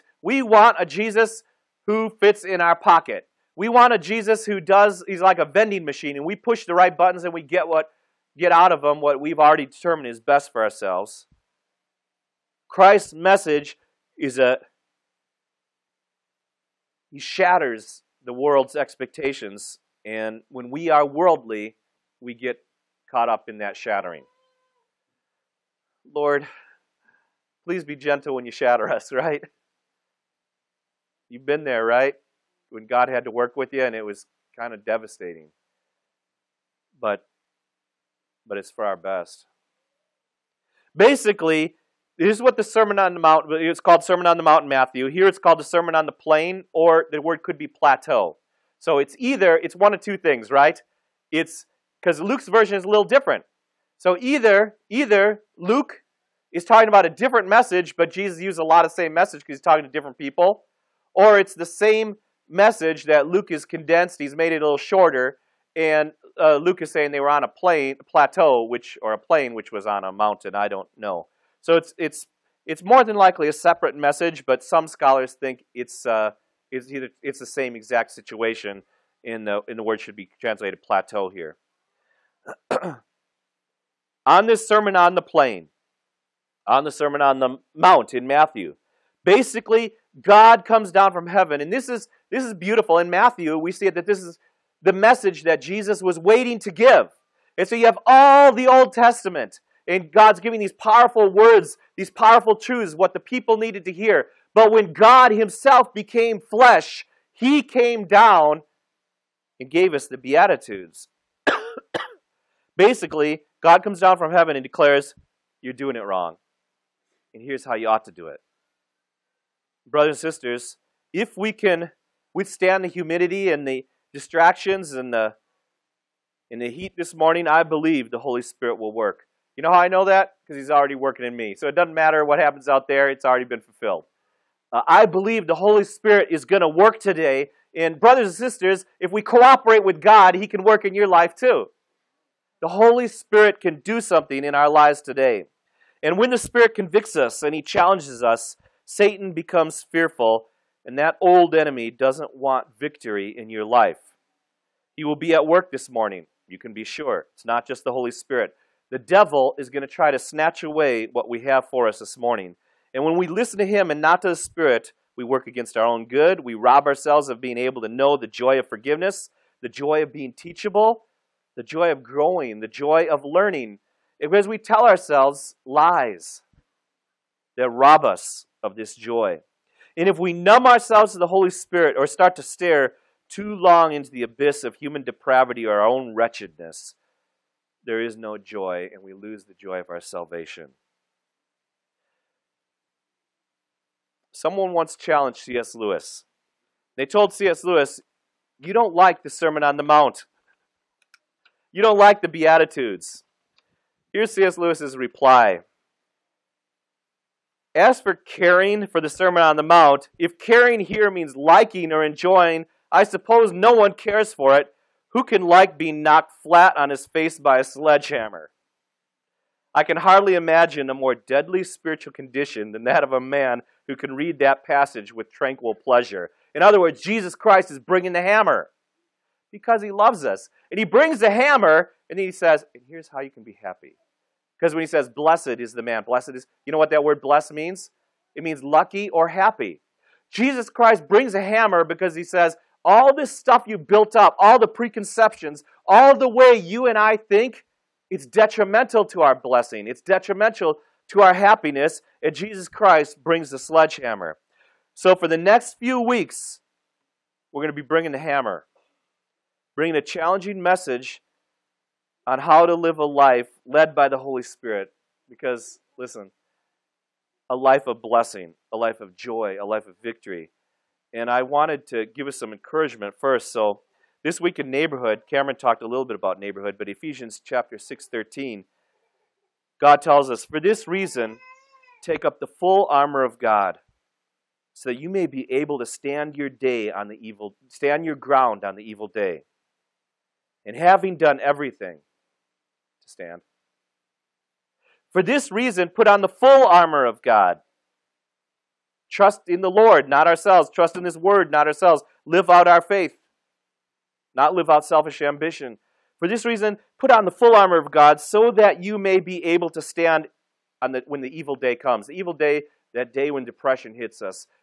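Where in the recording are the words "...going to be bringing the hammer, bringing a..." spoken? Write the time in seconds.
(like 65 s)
257 s.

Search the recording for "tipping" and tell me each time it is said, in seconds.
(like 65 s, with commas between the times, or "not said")
not said.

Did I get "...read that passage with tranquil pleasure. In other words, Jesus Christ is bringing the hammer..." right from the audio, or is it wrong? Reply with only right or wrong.
right.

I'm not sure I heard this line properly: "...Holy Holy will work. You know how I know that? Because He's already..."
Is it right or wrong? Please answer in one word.
wrong.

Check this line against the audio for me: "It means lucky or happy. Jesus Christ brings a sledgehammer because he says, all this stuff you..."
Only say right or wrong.
wrong.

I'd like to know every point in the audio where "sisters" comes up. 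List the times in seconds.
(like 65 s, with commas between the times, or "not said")
120 s, 138 s.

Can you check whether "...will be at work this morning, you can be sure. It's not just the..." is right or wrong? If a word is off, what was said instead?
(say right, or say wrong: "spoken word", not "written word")
right.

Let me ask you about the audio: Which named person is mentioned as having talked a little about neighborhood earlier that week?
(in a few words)
Cameron.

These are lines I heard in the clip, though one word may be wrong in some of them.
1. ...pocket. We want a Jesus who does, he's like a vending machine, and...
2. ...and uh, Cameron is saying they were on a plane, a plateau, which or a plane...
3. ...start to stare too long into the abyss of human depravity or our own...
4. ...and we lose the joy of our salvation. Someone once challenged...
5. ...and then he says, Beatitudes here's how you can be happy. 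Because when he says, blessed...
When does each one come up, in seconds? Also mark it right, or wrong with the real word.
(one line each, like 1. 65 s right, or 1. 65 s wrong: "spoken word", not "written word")
1. 2 s right
2. 65 s wrong: "Luke", not "Cameron"
3. 182 s right
4. 188 s right
5. 232 s wrong: "And", not "Beatitudes".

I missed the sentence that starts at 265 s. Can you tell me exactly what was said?
Because, listen, a life of blessing, a life of joy, a life of victory.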